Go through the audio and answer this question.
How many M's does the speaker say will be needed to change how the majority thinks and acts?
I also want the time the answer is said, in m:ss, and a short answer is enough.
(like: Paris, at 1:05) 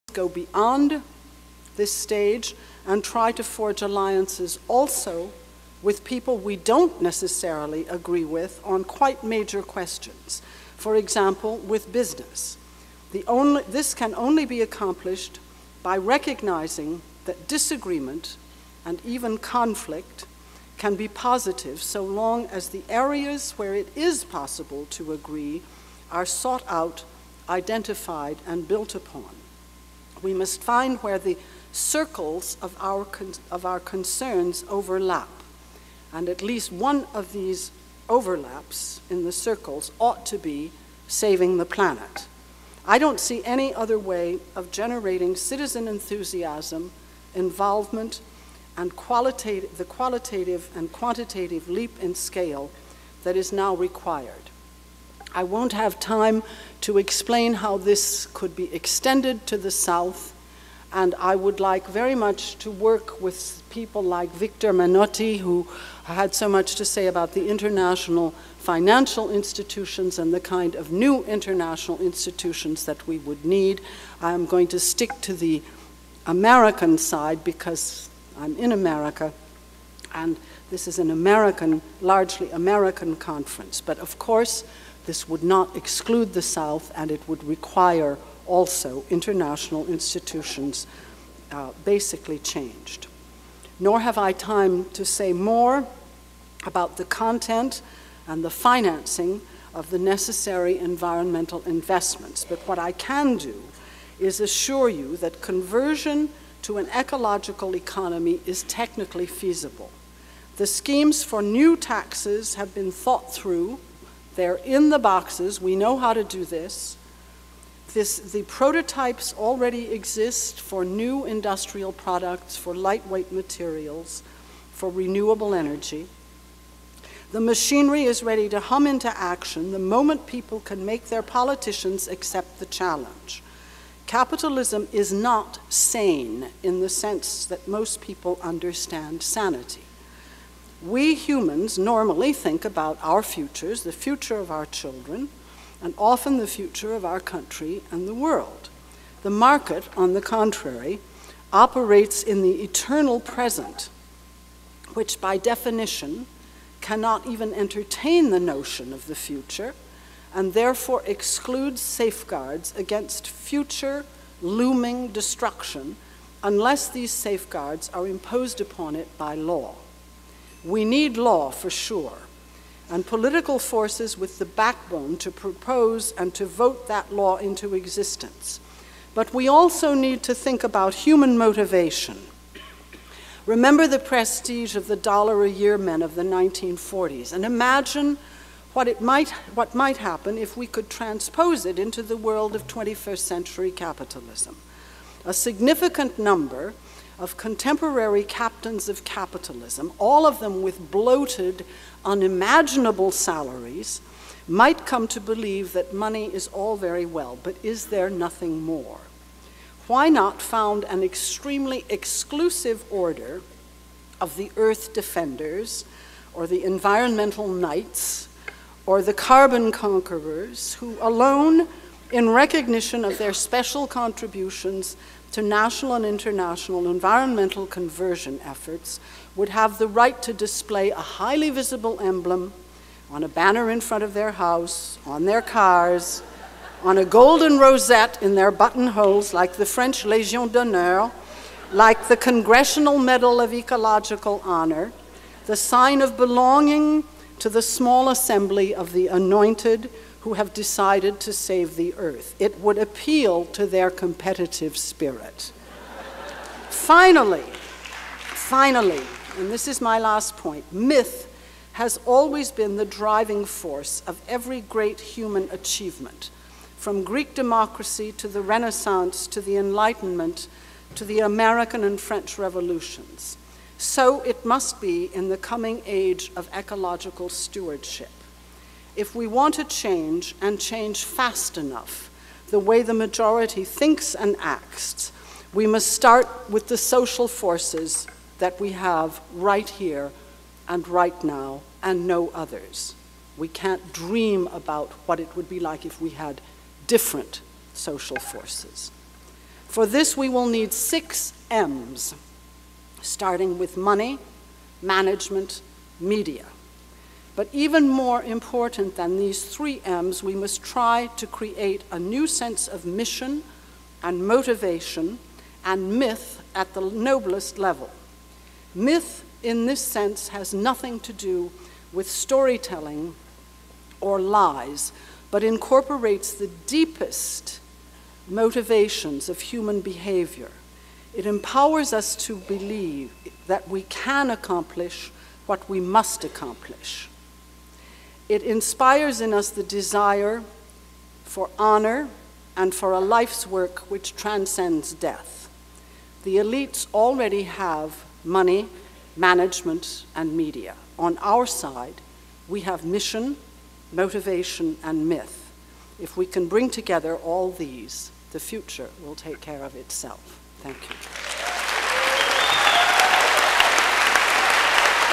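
6, at 5:00.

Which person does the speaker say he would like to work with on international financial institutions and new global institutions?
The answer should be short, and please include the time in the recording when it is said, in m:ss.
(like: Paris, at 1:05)
Victor Menotti, at 1:04.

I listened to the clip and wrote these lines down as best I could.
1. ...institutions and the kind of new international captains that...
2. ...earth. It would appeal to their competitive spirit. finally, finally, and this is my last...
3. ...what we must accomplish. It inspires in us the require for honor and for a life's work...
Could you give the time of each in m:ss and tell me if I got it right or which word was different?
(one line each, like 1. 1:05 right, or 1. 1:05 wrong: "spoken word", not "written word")
1. 1:09 wrong: "institutions", not "captains"
2. 4:11 right
3. 5:35 wrong: "desire", not "require".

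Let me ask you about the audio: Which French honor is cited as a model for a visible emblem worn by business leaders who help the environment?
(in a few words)
Legion d'honneur.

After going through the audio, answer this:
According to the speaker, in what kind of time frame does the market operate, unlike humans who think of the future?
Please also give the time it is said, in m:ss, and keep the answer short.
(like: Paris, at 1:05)
the eternal present, at 2:32.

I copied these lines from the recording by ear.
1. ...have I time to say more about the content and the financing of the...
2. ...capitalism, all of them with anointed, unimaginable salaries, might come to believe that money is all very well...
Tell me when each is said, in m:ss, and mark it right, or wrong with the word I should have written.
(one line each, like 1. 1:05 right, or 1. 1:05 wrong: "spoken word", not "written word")
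1. 1:34 right
2. 3:19 wrong: "bloated", not "anointed".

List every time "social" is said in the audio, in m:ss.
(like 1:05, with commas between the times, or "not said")
4:46, 4:57.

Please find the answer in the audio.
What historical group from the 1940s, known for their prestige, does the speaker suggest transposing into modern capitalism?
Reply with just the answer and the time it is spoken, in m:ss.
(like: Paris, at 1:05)
dollar a year men, at 3:04.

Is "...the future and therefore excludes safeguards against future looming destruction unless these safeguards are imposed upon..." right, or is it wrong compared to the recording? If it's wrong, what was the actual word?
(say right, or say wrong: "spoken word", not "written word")
right.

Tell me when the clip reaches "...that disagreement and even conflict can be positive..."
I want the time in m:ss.
0:17.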